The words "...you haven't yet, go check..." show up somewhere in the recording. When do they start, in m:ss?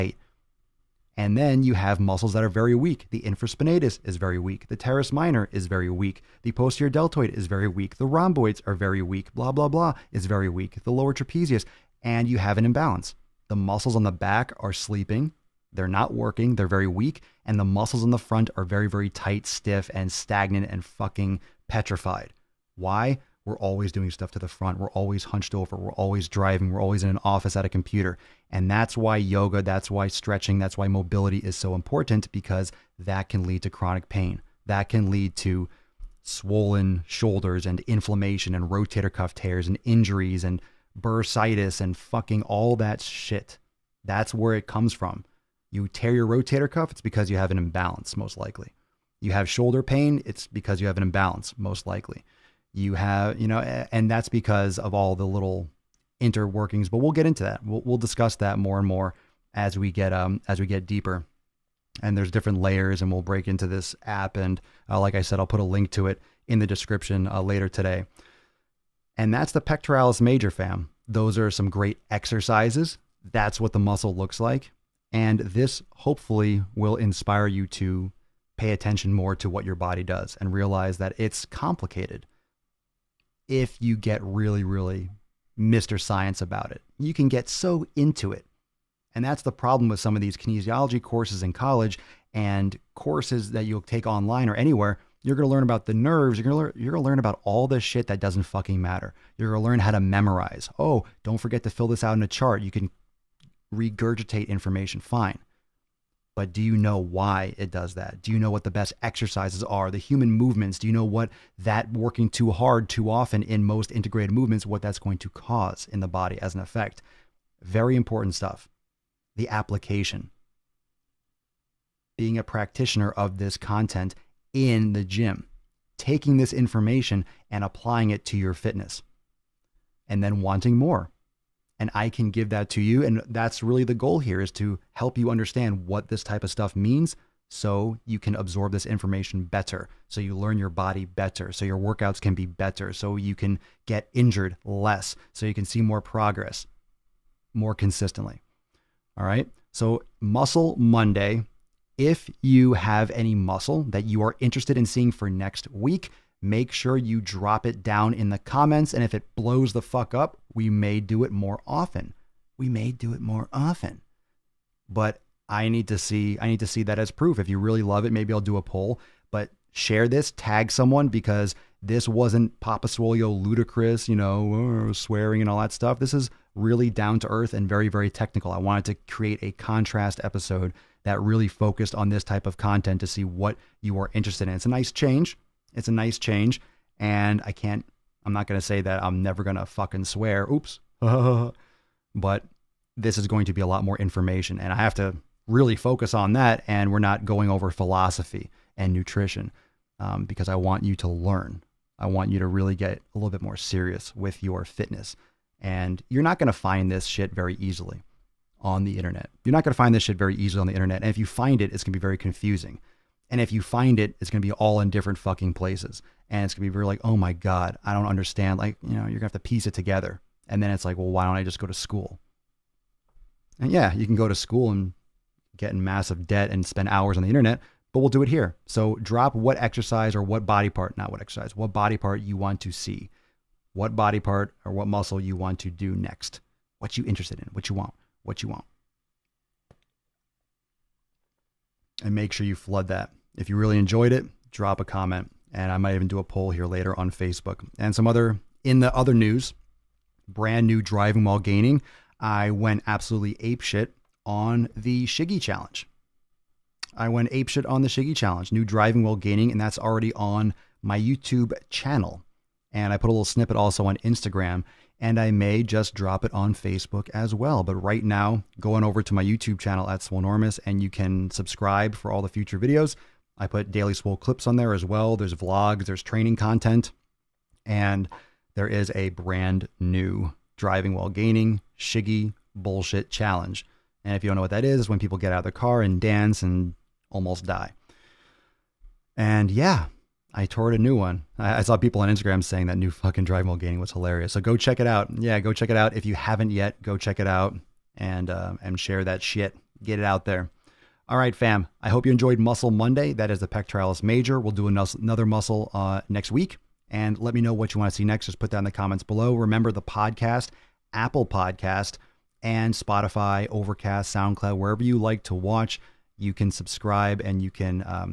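4:56.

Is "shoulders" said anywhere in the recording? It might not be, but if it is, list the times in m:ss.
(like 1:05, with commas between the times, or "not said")
0:37, 0:49.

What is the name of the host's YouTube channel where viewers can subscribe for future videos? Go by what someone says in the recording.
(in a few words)
Swolenormous.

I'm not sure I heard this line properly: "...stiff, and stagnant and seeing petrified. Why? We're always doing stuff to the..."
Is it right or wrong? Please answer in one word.
wrong.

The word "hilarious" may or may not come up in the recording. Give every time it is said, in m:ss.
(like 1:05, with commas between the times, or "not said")
4:53.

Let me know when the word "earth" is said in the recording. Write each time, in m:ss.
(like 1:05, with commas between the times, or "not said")
2:57.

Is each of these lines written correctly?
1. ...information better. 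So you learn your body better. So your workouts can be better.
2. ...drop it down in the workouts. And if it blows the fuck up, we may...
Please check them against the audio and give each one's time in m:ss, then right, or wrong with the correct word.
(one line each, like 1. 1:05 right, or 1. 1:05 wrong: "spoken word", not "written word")
1. 2:18 right
2. 2:37 wrong: "comments", not "workouts".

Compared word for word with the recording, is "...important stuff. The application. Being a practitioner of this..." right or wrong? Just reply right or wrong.
right.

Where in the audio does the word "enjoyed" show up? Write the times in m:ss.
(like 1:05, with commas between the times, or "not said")
4:03, 5:02.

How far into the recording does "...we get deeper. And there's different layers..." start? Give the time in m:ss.
1:00.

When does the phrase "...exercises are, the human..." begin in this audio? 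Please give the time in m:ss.
1:49.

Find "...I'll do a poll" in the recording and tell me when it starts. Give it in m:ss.
2:48.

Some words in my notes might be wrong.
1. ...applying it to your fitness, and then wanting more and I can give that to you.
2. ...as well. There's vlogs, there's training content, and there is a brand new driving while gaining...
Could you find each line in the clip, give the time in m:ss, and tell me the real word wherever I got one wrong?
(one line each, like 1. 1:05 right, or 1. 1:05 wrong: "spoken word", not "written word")
1. 2:07 right
2. 4:34 right.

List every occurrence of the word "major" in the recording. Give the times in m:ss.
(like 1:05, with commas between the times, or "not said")
1:10, 5:04.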